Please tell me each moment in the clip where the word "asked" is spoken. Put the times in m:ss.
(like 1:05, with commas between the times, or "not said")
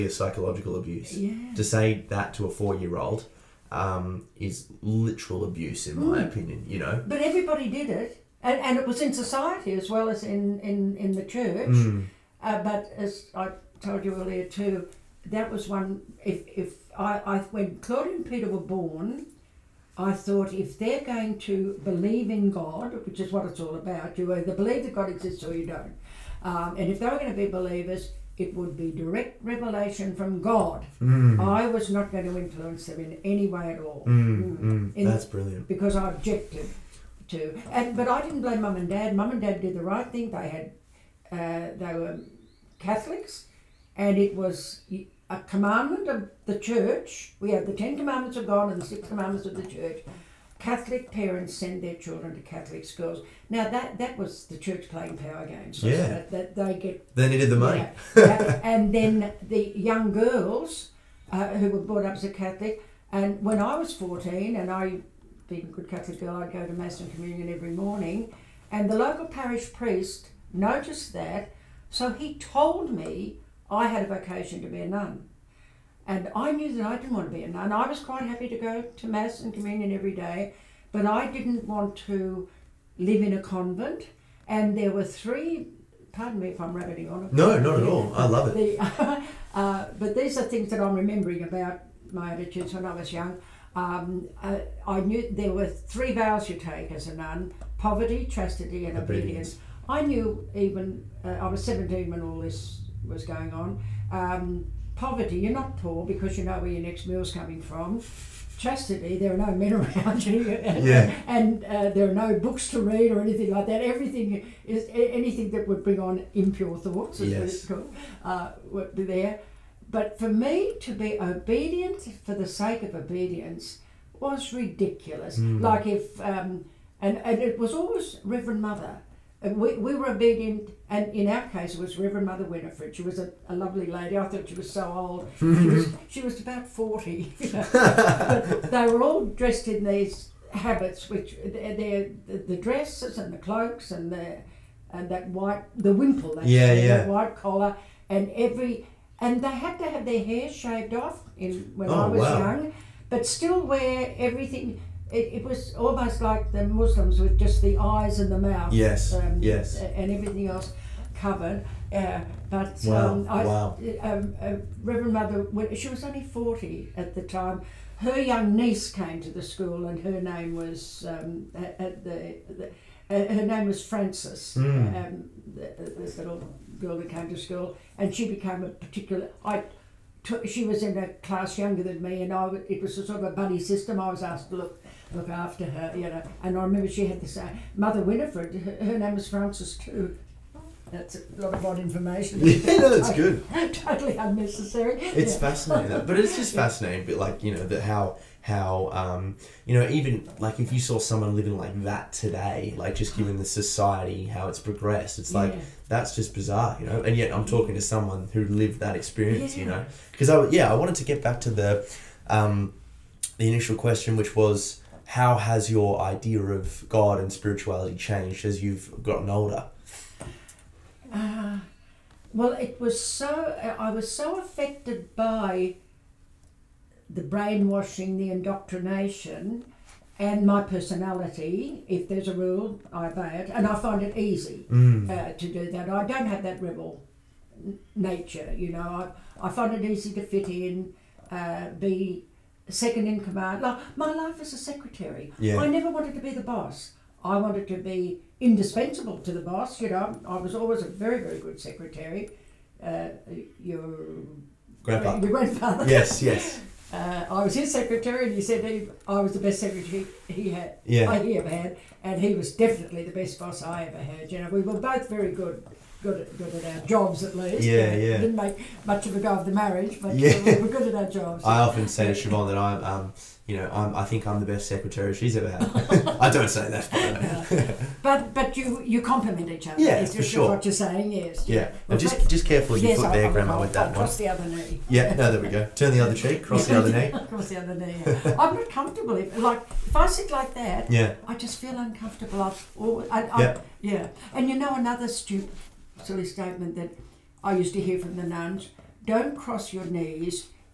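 3:04.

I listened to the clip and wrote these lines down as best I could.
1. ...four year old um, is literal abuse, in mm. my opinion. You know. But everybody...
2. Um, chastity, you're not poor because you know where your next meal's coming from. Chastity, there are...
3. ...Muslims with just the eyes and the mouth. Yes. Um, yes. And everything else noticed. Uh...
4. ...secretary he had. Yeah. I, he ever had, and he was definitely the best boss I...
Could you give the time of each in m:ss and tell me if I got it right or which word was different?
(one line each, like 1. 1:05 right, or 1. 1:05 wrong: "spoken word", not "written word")
1. 0:02 right
2. 1:44 wrong: "poverty", not "chastity"
3. 2:36 wrong: "covered", not "noticed"
4. 4:19 right.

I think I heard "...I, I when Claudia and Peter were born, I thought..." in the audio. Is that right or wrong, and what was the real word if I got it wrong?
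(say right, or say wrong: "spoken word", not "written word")
right.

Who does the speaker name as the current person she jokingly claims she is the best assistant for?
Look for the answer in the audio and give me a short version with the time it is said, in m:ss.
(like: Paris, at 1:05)
Siobhan, at 4:32.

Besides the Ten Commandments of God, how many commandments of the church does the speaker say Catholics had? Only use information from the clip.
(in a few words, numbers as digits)
6.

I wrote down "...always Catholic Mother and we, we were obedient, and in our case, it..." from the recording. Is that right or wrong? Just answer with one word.
wrong.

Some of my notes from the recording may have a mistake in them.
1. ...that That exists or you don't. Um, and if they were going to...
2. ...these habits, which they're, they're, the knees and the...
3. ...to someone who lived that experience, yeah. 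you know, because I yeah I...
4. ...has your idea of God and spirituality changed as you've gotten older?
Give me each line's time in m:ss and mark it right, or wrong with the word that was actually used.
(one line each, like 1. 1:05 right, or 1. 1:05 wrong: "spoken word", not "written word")
1. 0:24 wrong: "God", not "That"
2. 2:19 wrong: "dresses", not "knees"
3. 3:27 right
4. 3:35 right.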